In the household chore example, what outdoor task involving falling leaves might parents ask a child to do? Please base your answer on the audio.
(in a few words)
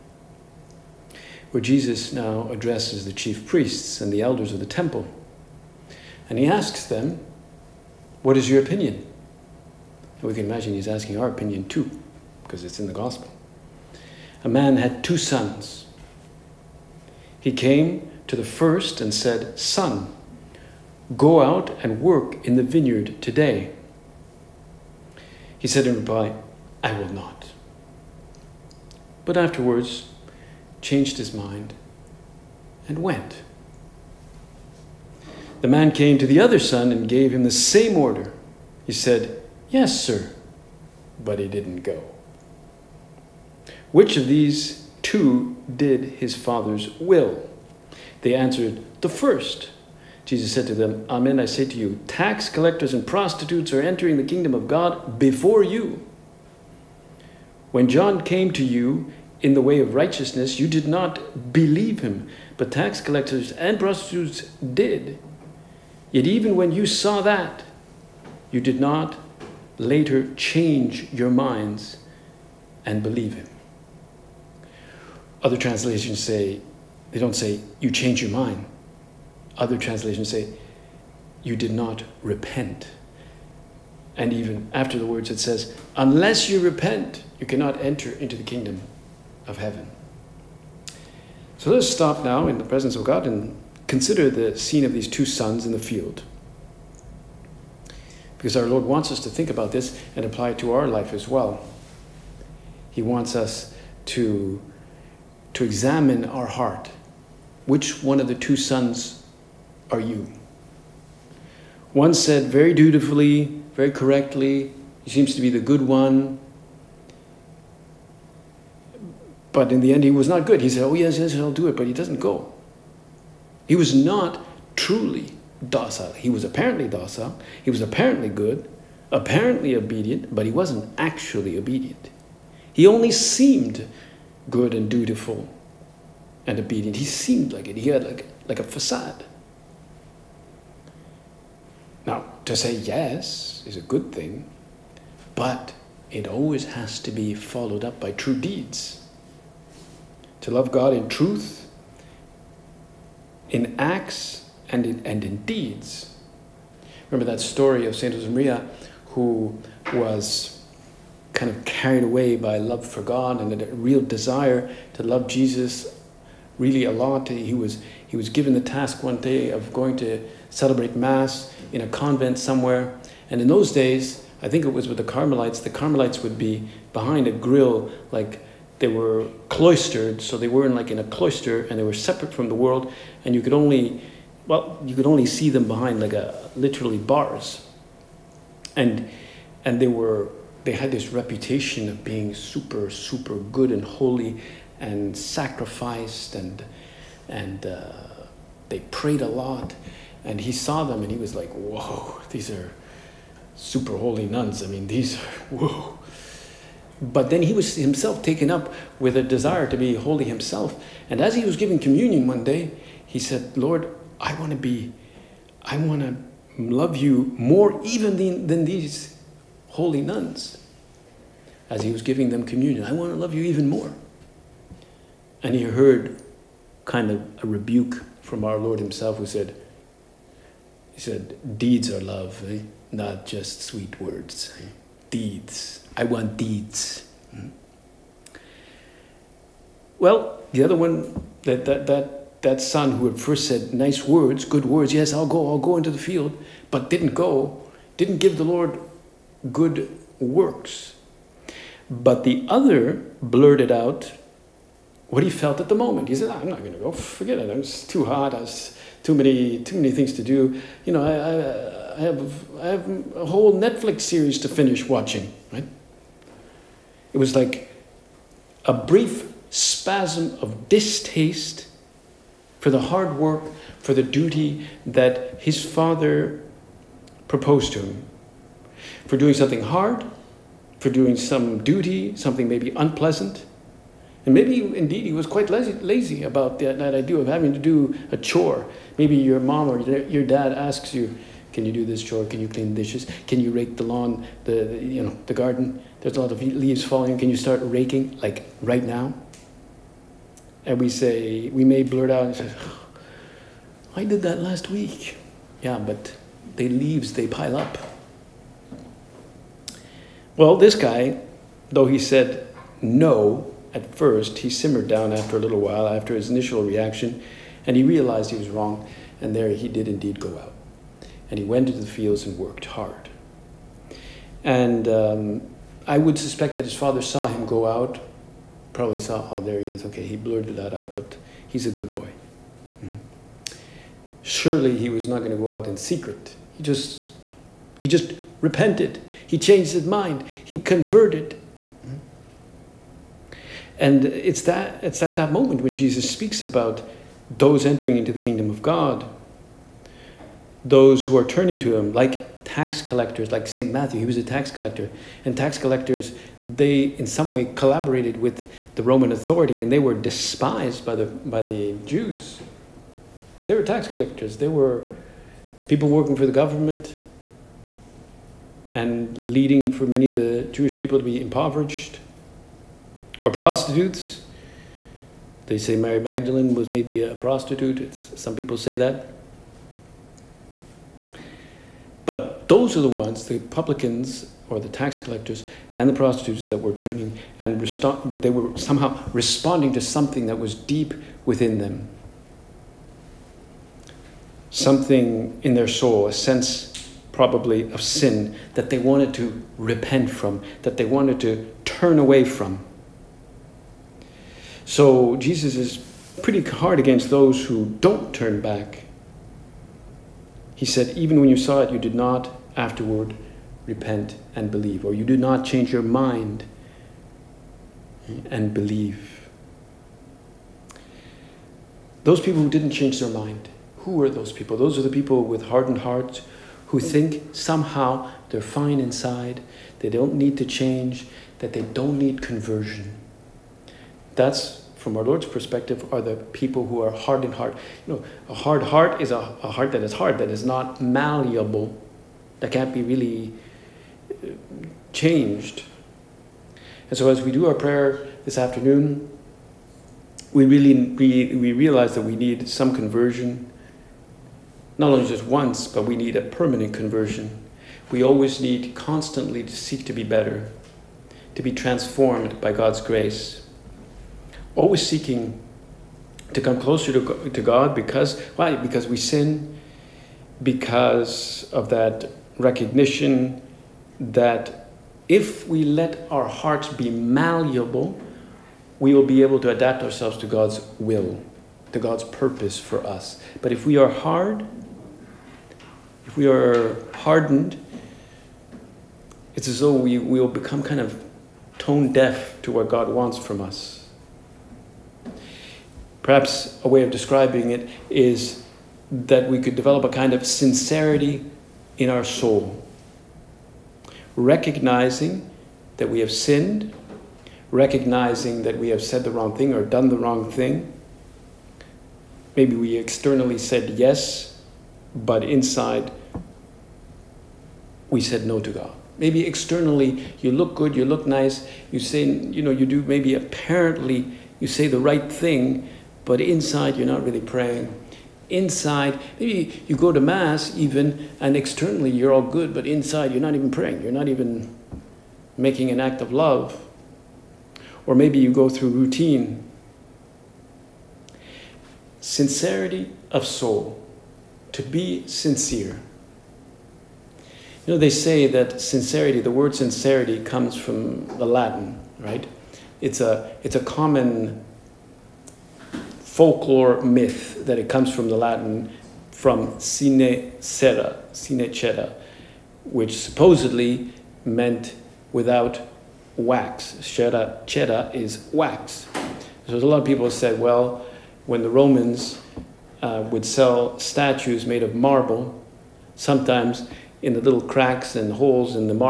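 rake the lawn.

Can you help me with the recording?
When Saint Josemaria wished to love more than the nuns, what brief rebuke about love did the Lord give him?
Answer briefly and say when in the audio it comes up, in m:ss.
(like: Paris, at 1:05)
deeds are love, at 3:51.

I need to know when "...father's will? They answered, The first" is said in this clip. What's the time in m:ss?
0:46.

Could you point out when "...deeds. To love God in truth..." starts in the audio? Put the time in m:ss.
2:28.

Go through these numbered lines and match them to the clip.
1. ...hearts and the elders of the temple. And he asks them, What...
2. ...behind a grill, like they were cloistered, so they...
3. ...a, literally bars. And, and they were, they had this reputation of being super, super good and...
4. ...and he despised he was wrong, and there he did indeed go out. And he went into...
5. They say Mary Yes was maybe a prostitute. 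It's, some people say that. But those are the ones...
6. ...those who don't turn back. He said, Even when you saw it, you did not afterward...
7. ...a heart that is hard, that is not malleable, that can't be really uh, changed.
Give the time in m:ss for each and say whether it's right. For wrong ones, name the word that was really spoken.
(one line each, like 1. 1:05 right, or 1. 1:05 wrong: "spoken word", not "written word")
1. 0:03 wrong: "priests", not "hearts"
2. 2:56 right
3. 3:06 right
4. 5:17 wrong: "realized", not "despised"
5. 6:15 wrong: "Magdalene", not "Yes"
6. 6:47 right
7. 7:19 right.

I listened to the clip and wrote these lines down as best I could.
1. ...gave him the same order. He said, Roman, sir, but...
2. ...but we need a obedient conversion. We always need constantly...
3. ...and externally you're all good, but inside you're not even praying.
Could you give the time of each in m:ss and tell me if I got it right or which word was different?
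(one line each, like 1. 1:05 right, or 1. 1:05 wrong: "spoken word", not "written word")
1. 0:37 wrong: "Yes", not "Roman"
2. 7:35 wrong: "permanent", not "obedient"
3. 8:51 right.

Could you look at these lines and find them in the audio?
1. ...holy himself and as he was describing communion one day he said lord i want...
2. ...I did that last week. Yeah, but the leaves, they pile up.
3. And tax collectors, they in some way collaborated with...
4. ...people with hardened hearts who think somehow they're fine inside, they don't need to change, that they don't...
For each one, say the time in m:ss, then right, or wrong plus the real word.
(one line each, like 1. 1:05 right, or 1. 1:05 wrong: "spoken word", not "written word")
1. 3:29 wrong: "giving", not "describing"
2. 5:03 right
3. 5:55 right
4. 7:04 right.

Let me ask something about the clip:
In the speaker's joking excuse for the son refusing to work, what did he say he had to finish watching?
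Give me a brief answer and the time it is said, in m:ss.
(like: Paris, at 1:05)
a whole Netflix series, at 4:23.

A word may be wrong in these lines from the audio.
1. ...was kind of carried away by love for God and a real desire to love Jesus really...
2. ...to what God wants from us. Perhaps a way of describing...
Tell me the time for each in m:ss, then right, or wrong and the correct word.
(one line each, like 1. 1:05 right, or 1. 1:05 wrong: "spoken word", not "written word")
1. 2:39 right
2. 8:12 right.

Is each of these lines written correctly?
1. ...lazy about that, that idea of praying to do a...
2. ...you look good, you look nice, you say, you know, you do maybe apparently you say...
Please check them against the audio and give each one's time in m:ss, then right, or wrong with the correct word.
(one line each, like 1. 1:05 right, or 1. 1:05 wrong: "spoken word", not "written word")
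1. 4:45 wrong: "having", not "praying"
2. 8:40 right.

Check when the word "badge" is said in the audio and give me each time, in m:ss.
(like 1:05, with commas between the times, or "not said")
not said.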